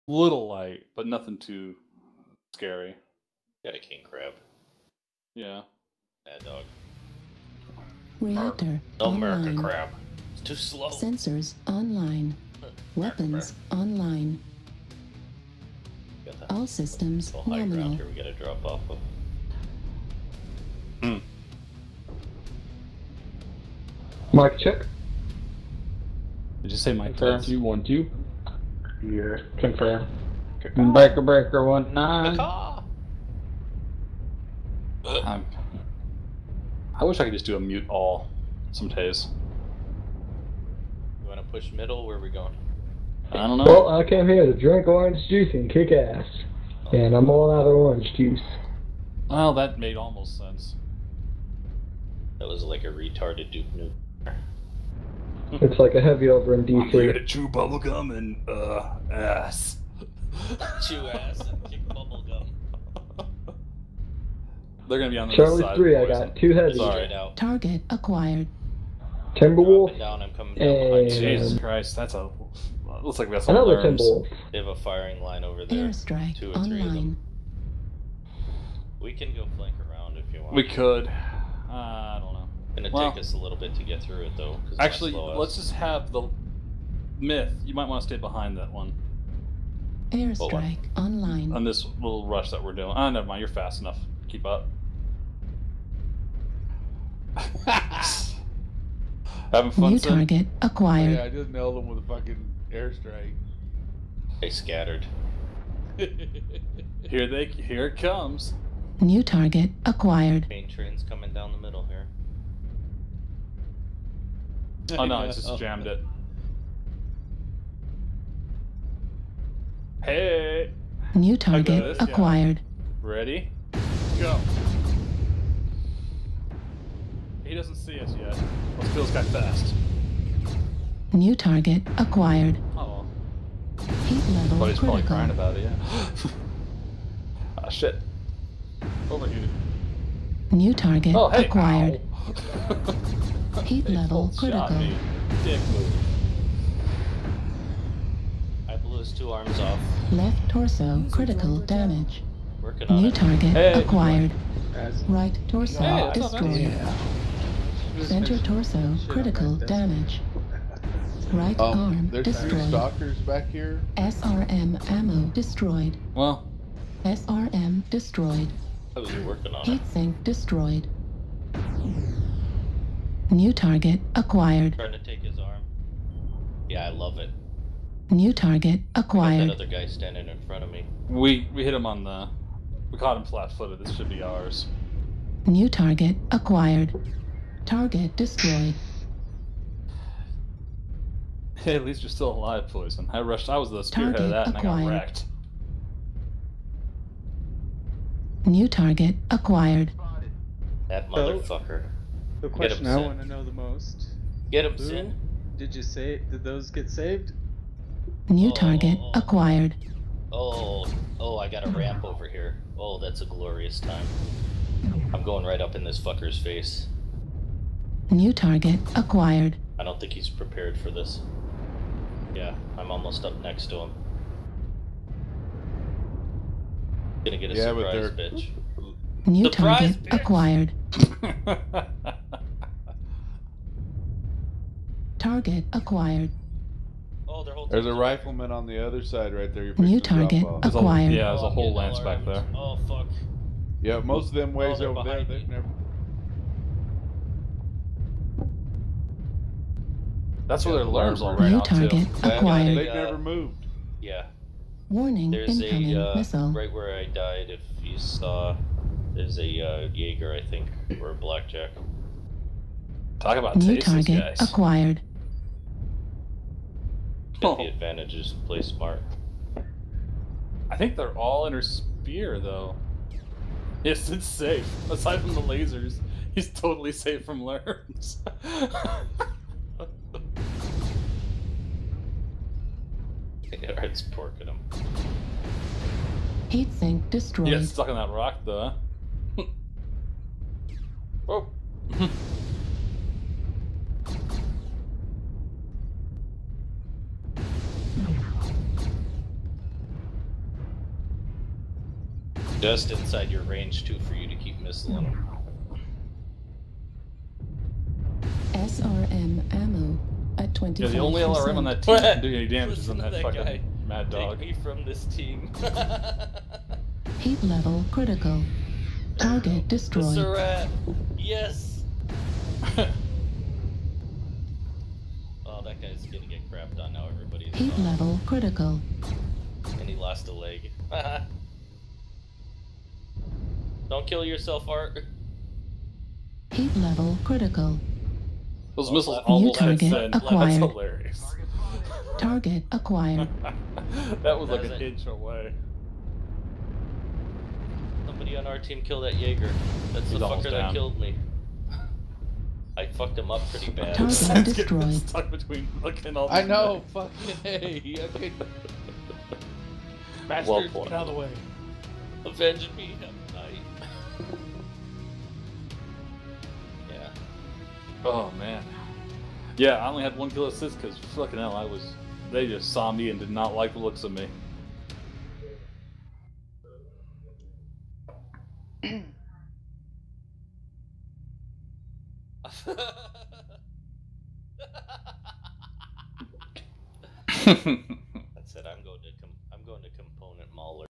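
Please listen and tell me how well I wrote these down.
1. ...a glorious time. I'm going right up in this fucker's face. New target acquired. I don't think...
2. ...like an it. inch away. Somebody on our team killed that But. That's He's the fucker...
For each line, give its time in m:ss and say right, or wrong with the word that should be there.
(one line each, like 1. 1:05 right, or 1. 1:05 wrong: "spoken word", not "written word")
1. 3:33 right
2. 5:44 wrong: "Jaeger", not "But".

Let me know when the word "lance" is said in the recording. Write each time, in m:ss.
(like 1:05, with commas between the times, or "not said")
4:01.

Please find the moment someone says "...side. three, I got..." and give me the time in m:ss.
1:05.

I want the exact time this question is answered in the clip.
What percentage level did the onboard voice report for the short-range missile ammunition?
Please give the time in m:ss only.
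5:10.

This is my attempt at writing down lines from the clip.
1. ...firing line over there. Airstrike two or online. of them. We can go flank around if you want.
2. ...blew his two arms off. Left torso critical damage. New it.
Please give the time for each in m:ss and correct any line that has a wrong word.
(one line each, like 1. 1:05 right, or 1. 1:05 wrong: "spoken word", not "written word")
1. 1:14 right
2. 2:28 right.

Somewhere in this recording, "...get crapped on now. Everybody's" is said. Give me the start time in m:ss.
5:26.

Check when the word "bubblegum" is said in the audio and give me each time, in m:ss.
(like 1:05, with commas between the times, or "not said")
0:57, 1:01.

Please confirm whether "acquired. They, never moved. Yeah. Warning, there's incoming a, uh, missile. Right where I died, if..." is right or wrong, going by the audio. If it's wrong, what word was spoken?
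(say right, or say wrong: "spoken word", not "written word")
right.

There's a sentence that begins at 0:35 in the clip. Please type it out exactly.
i I wish I could just do a mute all some days.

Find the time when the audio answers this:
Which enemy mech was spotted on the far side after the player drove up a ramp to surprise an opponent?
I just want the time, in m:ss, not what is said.
3:57.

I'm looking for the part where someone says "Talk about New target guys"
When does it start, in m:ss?
4:23.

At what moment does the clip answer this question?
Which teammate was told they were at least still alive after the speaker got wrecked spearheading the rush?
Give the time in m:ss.
3:12.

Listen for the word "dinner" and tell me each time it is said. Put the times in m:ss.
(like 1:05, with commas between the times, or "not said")
not said.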